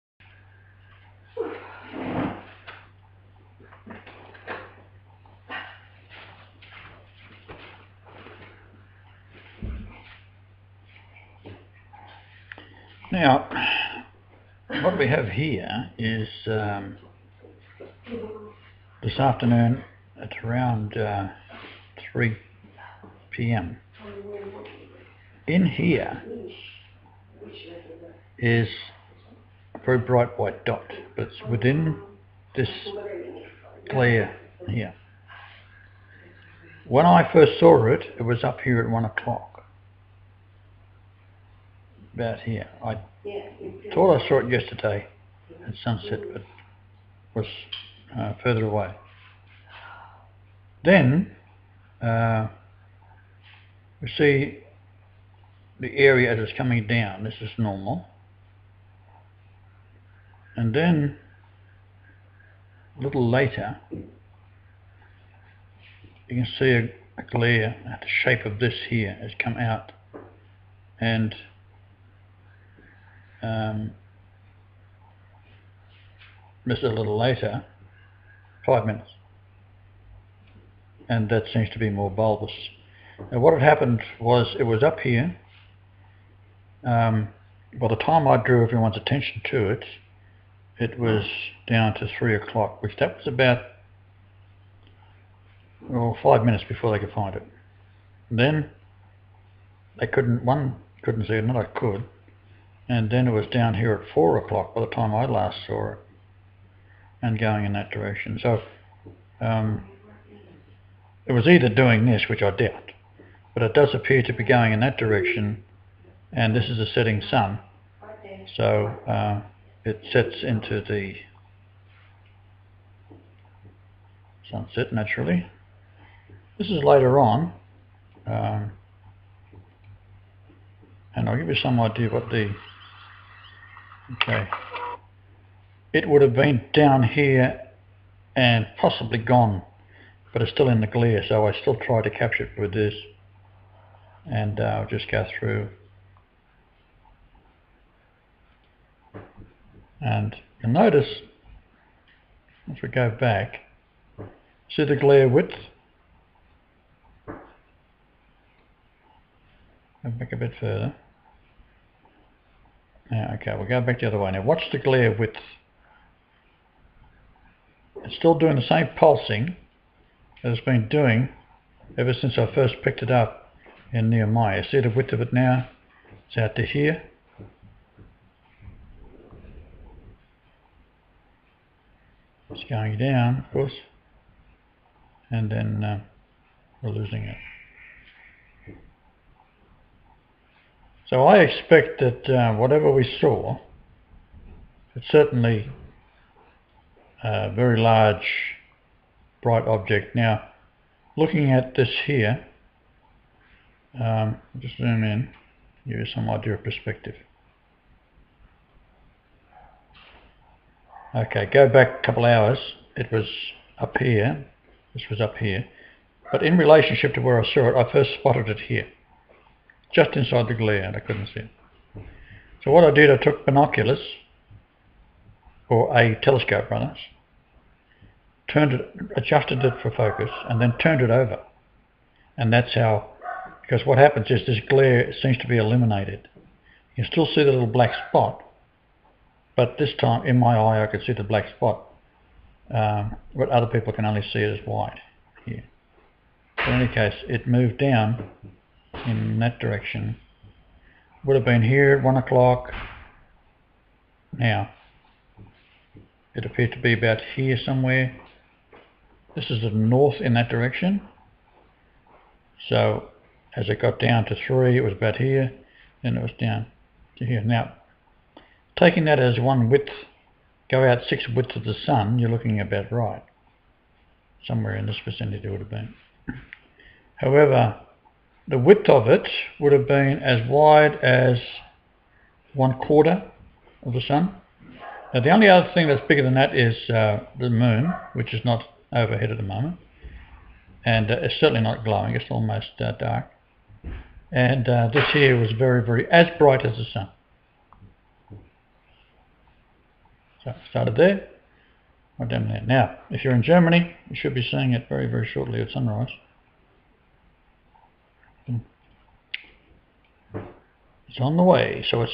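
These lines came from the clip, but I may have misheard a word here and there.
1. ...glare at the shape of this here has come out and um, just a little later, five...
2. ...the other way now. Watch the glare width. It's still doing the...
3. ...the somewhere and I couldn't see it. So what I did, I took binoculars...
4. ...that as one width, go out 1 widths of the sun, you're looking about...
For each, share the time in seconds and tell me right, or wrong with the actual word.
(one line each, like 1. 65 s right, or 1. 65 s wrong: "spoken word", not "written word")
1. 67 s right
2. 163 s right
3. 220 s wrong: "glare", not "somewhere"
4. 269 s wrong: "6", not "1".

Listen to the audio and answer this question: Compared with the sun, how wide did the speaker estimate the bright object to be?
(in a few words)
one quarter of the sun.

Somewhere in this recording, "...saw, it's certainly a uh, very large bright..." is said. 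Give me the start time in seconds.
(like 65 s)
193 s.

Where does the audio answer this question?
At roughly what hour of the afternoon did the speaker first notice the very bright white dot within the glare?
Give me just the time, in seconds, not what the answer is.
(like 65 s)
22 s.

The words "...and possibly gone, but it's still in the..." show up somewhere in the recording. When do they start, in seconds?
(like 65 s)
138 s.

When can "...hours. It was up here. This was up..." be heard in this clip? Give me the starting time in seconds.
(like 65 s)
212 s.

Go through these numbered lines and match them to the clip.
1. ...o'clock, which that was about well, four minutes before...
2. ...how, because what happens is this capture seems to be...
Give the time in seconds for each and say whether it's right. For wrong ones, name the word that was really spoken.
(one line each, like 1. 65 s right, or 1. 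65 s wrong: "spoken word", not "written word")
1. 92 s wrong: "five", not "four"
2. 232 s wrong: "glare", not "capture".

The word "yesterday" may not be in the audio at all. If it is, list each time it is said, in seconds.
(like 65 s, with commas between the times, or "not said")
44 s.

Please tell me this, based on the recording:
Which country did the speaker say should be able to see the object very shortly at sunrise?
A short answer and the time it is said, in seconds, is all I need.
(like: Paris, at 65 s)
Germany, at 303 s.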